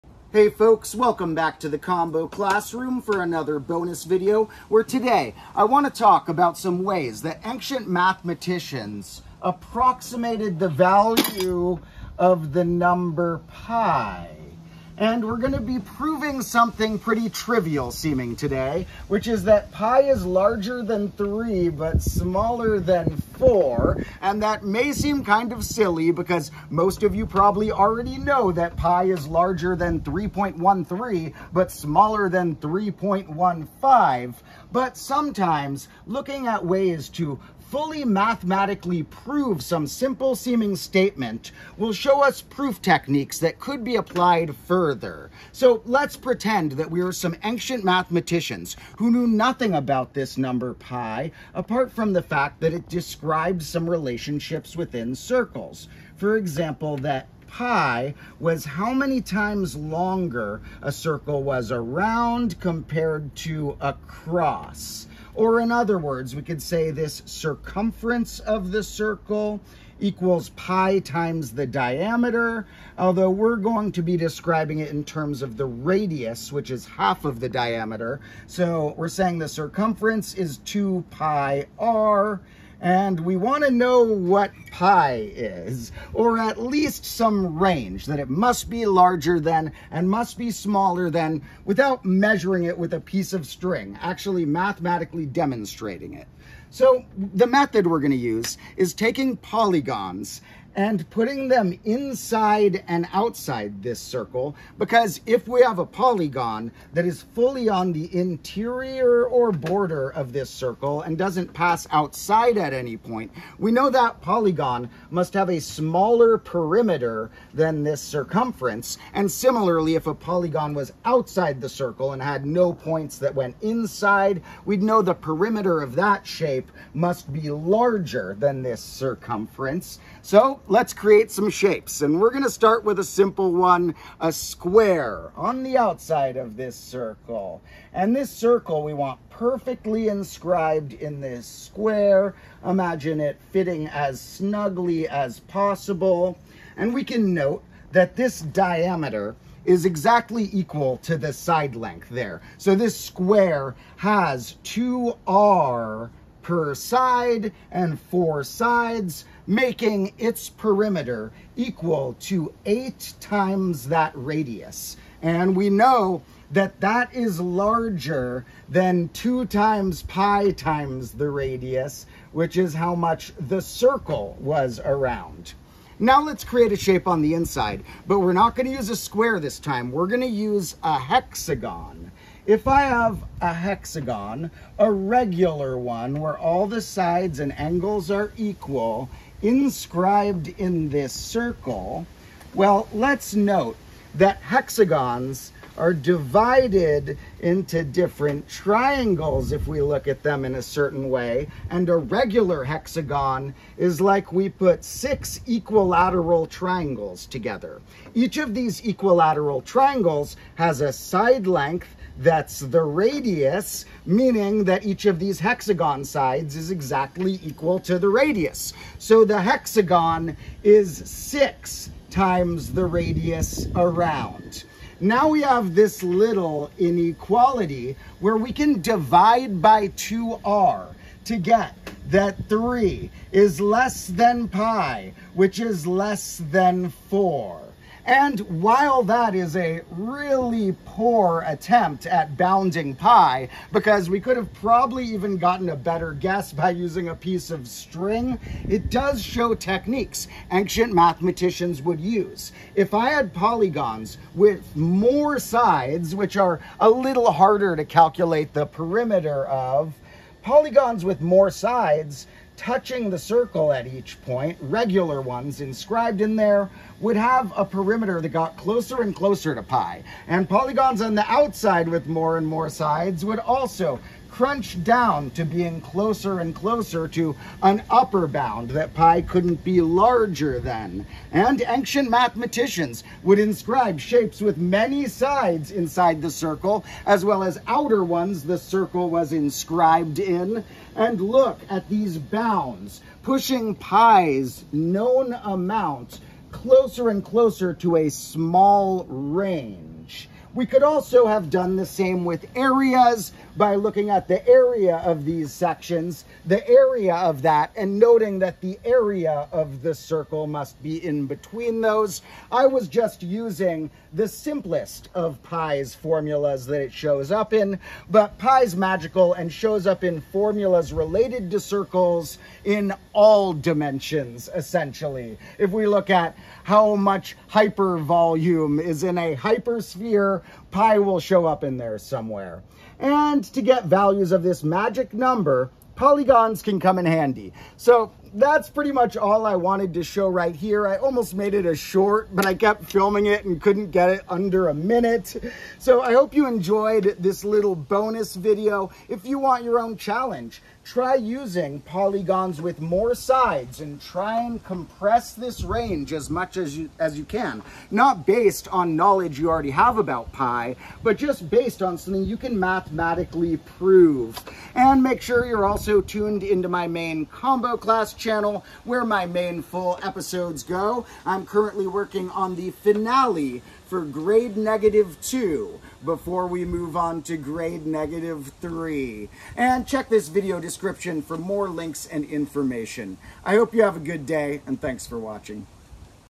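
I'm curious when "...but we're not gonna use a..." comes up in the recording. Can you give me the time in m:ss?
2:58.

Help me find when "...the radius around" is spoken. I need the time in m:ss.
3:42.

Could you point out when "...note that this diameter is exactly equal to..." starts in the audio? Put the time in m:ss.
2:27.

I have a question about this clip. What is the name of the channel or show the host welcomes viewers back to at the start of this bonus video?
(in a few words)
Combo Classroom.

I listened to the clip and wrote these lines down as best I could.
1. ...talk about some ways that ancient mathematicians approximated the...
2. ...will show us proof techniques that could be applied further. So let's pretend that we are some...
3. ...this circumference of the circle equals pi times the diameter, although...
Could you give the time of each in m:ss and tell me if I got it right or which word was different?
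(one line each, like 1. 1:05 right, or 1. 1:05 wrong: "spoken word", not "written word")
1. 0:05 right
2. 0:41 right
3. 1:06 right.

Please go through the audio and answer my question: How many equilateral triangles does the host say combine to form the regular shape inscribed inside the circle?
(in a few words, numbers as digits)
6.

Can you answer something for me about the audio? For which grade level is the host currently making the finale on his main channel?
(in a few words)
grade -2.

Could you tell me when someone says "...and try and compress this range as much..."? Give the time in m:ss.
5:53.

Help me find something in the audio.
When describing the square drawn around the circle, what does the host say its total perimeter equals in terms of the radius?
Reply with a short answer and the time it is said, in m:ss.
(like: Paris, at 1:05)
8 times the radius, at 2:42.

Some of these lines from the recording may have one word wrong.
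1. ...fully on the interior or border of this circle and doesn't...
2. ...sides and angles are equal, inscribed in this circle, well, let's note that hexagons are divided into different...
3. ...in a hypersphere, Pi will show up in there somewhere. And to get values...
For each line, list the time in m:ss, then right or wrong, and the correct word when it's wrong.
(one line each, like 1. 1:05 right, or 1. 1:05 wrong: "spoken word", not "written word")
1. 1:47 right
2. 3:06 right
3. 5:29 right.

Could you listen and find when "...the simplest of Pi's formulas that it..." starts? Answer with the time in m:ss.
5:14.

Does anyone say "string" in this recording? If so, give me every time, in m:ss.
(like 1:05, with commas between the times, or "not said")
1:33, 4:07.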